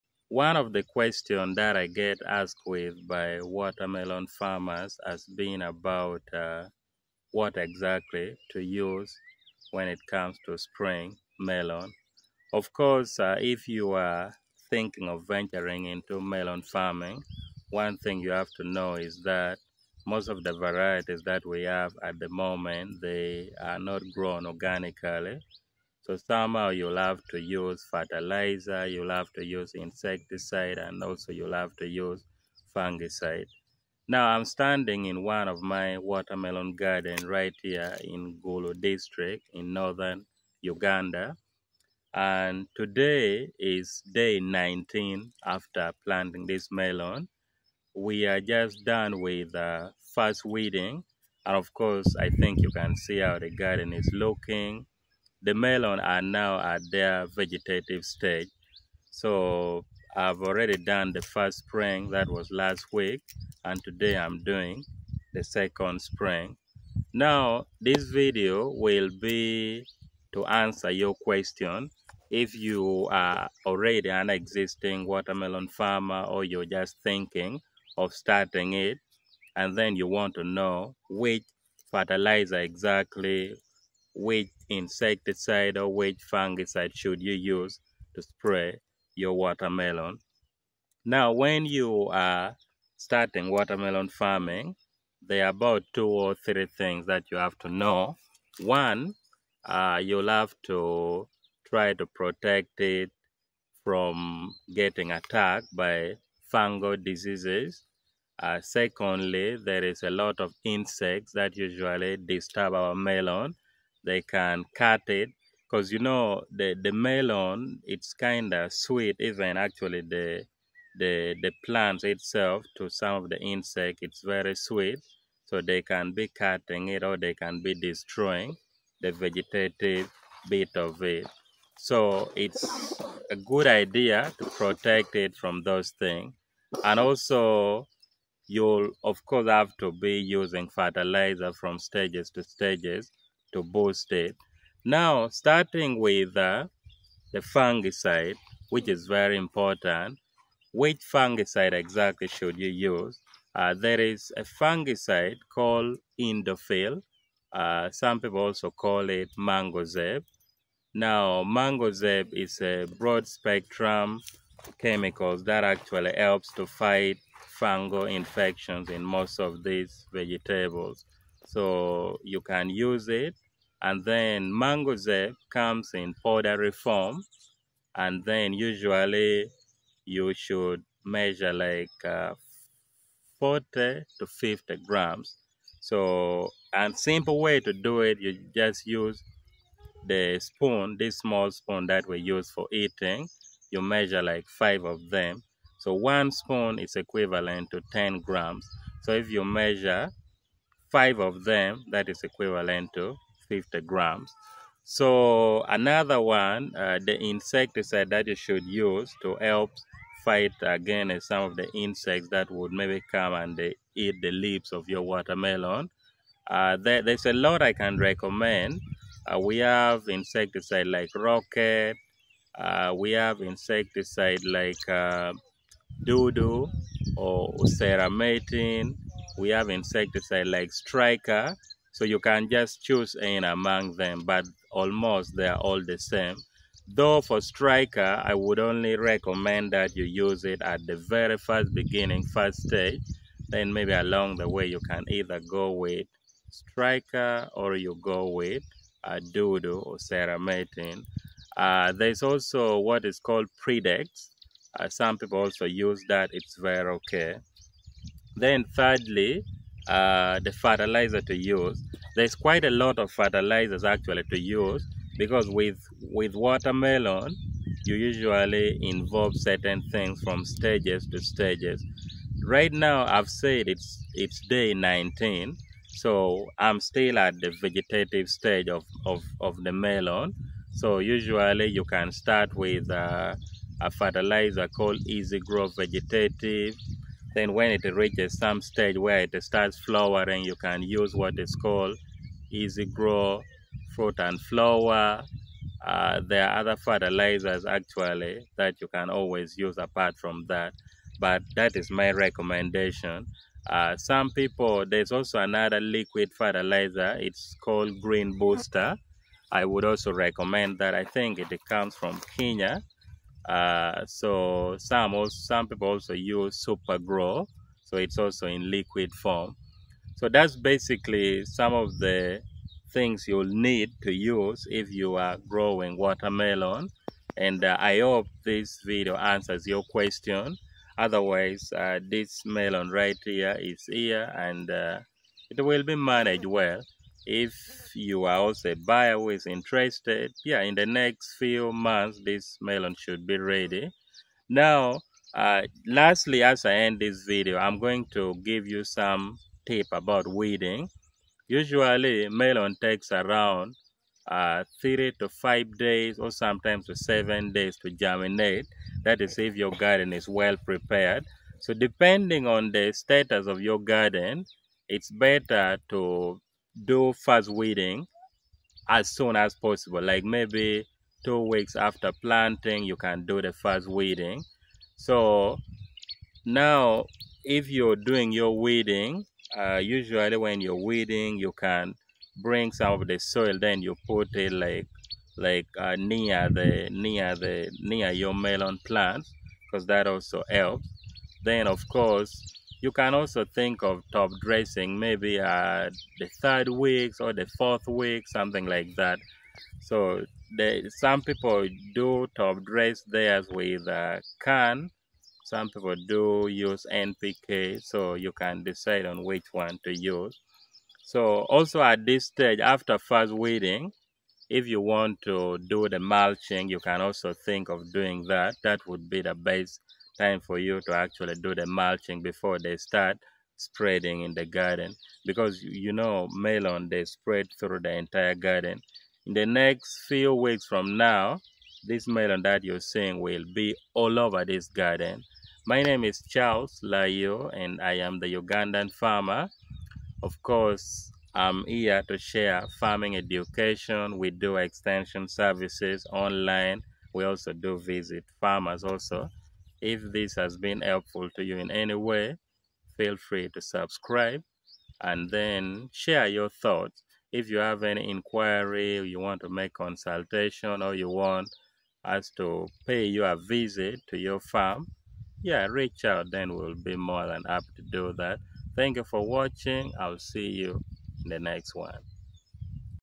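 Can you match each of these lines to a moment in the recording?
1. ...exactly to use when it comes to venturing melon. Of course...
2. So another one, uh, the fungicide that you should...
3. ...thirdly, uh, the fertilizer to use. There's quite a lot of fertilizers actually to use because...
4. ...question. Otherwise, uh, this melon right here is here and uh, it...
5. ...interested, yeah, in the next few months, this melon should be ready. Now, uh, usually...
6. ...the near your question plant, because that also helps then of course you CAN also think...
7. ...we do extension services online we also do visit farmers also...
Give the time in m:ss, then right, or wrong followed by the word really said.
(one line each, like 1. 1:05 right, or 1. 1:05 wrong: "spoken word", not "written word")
1. 0:07 wrong: "spring", not "venturing"
2. 3:24 wrong: "insecticide", not "fungicide"
3. 4:18 right
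4. 5:29 right
5. 5:39 wrong: "lastly", not "usually"
6. 6:27 wrong: "melon", not "question"
7. 7:24 right.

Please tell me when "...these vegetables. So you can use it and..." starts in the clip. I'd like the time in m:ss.
2:49.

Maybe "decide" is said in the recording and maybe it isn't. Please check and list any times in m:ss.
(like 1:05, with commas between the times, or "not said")
6:48.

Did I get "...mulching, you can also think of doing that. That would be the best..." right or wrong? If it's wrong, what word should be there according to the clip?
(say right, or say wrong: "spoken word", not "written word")
right.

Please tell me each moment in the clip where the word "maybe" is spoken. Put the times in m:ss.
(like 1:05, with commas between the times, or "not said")
3:32, 4:03, 6:10, 6:34.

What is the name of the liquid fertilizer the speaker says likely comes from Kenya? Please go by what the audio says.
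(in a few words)
Green Booster.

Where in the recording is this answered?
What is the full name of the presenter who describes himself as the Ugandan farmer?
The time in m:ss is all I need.
7:16.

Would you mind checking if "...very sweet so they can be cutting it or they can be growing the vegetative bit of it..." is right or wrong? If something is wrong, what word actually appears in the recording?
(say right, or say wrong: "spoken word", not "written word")
wrong: "destroying", not "growing".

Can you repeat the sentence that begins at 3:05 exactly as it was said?
So, and simple way to do it, you just use the spoon, this small spoon that we use for eating.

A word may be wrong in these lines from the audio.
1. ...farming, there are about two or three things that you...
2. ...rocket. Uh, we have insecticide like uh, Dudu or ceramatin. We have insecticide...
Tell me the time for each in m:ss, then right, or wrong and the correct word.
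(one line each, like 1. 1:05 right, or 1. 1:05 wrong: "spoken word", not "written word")
1. 1:34 right
2. 3:41 right.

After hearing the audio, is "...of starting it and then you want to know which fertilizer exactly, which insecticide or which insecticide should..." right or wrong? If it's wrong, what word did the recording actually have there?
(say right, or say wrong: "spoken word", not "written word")
wrong: "fungicide", not "insecticide".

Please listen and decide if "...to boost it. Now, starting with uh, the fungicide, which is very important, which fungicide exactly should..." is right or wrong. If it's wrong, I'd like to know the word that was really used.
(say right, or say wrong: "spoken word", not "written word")
right.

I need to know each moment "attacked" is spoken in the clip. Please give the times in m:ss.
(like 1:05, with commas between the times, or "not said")
1:45.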